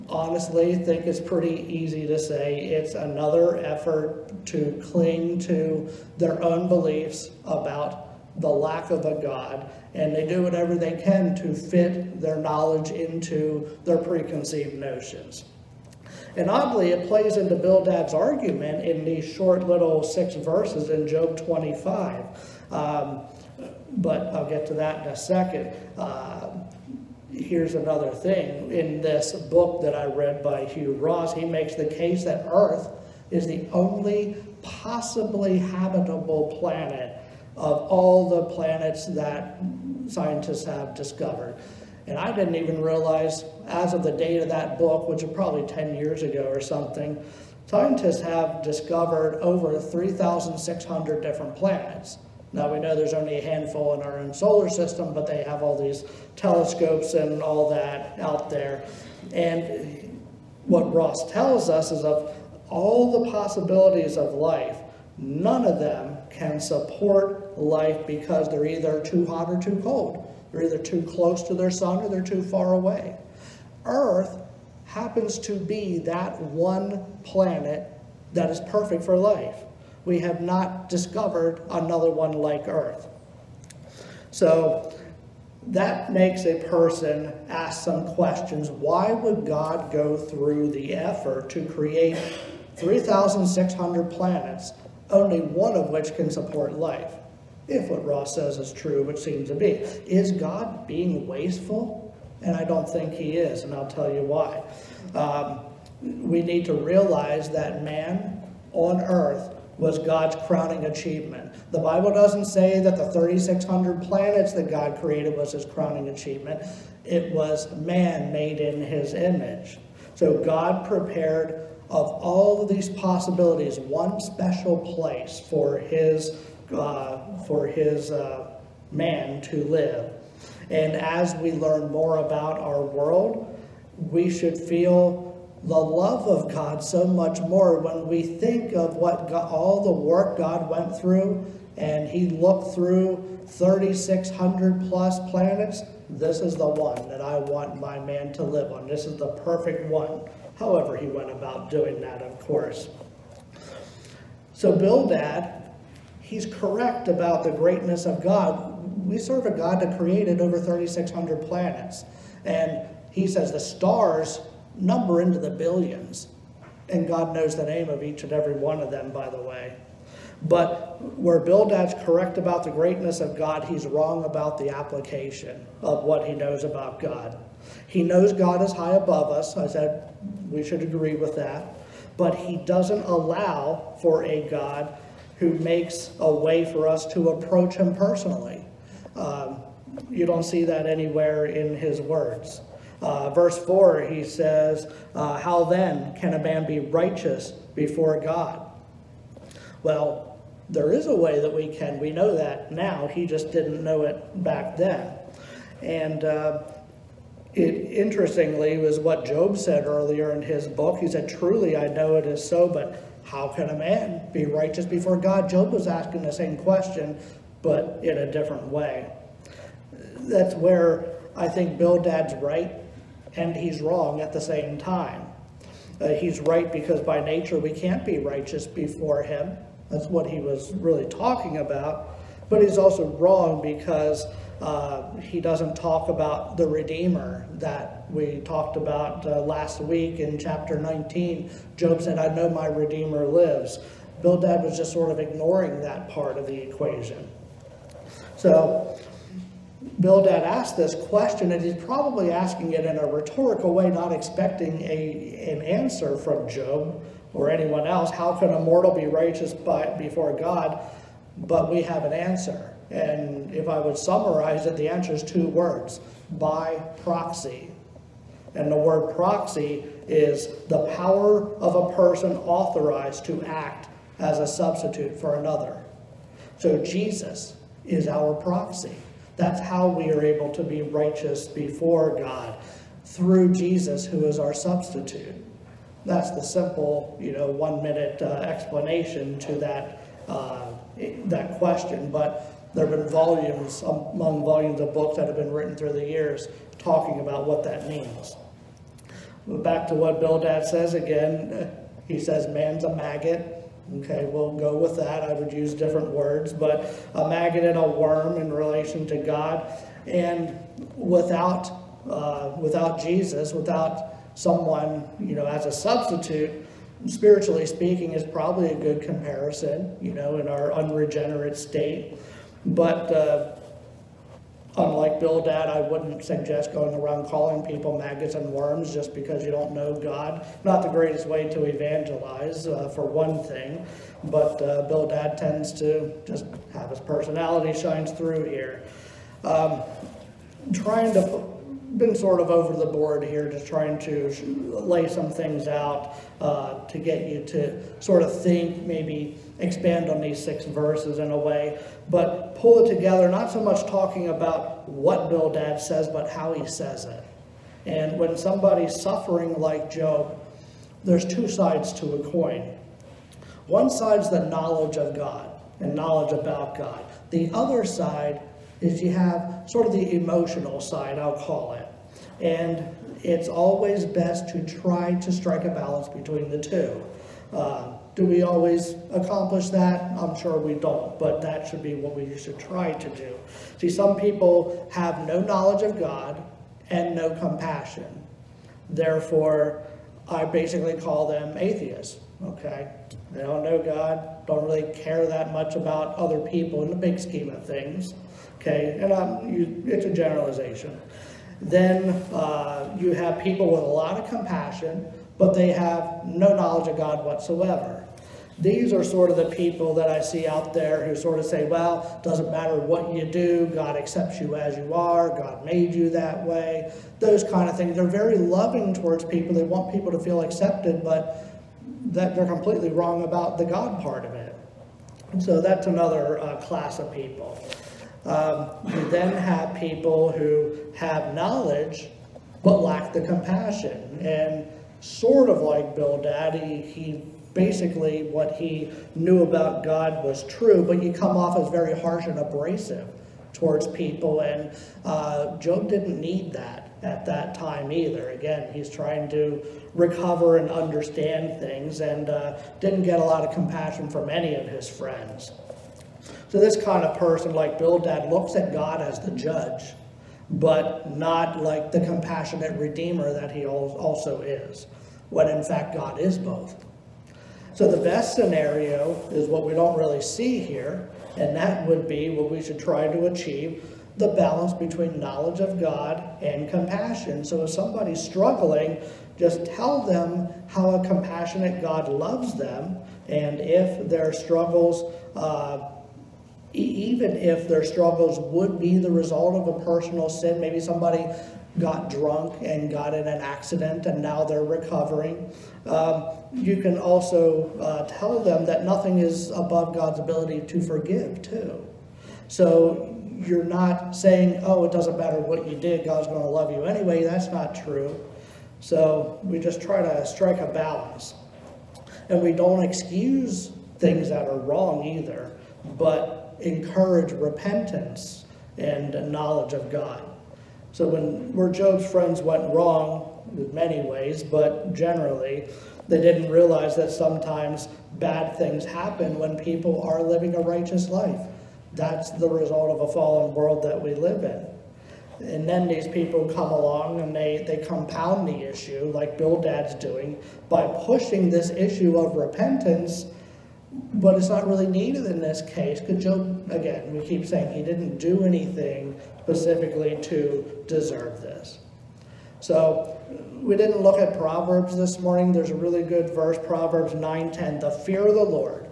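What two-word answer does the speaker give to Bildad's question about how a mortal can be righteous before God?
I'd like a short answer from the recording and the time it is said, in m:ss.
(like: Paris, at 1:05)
by proxy, at 4:26.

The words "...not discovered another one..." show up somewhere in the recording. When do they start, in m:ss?
1:20.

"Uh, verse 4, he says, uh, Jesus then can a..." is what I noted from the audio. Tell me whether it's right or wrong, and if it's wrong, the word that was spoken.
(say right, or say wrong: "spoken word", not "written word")
wrong: "How", not "Jesus".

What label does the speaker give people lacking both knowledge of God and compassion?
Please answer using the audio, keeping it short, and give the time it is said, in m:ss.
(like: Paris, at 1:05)
atheists, at 6:31.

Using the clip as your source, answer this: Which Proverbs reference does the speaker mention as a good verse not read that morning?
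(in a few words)
Proverbs 9:10.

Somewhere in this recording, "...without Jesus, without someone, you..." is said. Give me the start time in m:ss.
5:12.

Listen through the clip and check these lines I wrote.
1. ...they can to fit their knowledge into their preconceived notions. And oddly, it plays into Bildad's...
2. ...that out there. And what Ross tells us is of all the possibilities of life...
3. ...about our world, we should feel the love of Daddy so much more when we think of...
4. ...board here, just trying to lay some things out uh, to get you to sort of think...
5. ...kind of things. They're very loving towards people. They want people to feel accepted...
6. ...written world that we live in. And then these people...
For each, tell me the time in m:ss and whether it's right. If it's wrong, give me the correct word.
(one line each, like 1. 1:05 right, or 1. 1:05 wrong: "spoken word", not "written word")
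1. 0:10 right
2. 0:57 right
3. 2:12 wrong: "God", not "Daddy"
4. 5:42 right
5. 6:57 right
6. 8:53 wrong: "fallen", not "written".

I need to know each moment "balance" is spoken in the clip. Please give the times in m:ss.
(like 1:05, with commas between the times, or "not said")
6:15, 7:54, 8:30.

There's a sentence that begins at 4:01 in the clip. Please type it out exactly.
Job said, I know my Redeemer lives.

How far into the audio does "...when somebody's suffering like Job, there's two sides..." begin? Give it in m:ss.
5:58.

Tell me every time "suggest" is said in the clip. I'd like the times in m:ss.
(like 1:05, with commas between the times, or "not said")
5:26.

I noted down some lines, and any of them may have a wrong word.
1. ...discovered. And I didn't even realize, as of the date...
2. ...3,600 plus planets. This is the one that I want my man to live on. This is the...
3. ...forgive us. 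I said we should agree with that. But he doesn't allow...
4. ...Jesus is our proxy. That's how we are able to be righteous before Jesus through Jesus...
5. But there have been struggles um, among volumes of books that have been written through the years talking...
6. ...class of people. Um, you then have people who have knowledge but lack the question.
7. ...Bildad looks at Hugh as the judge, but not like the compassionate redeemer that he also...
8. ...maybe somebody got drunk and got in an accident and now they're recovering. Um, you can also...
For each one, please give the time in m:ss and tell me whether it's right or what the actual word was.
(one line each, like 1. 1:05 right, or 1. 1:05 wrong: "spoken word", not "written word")
1. 0:40 right
2. 2:23 right
3. 2:58 wrong: "above", not "forgive"
4. 4:36 wrong: "God", not "Jesus"
5. 4:52 wrong: "volumes", not "struggles"
6. 7:06 wrong: "compassion", not "question"
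7. 7:37 wrong: "God", not "Hugh"
8. 8:10 right.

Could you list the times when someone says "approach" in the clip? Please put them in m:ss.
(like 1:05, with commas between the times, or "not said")
3:07.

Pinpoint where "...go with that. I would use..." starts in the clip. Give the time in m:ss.
5:04.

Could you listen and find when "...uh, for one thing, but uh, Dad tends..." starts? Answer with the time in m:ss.
5:32.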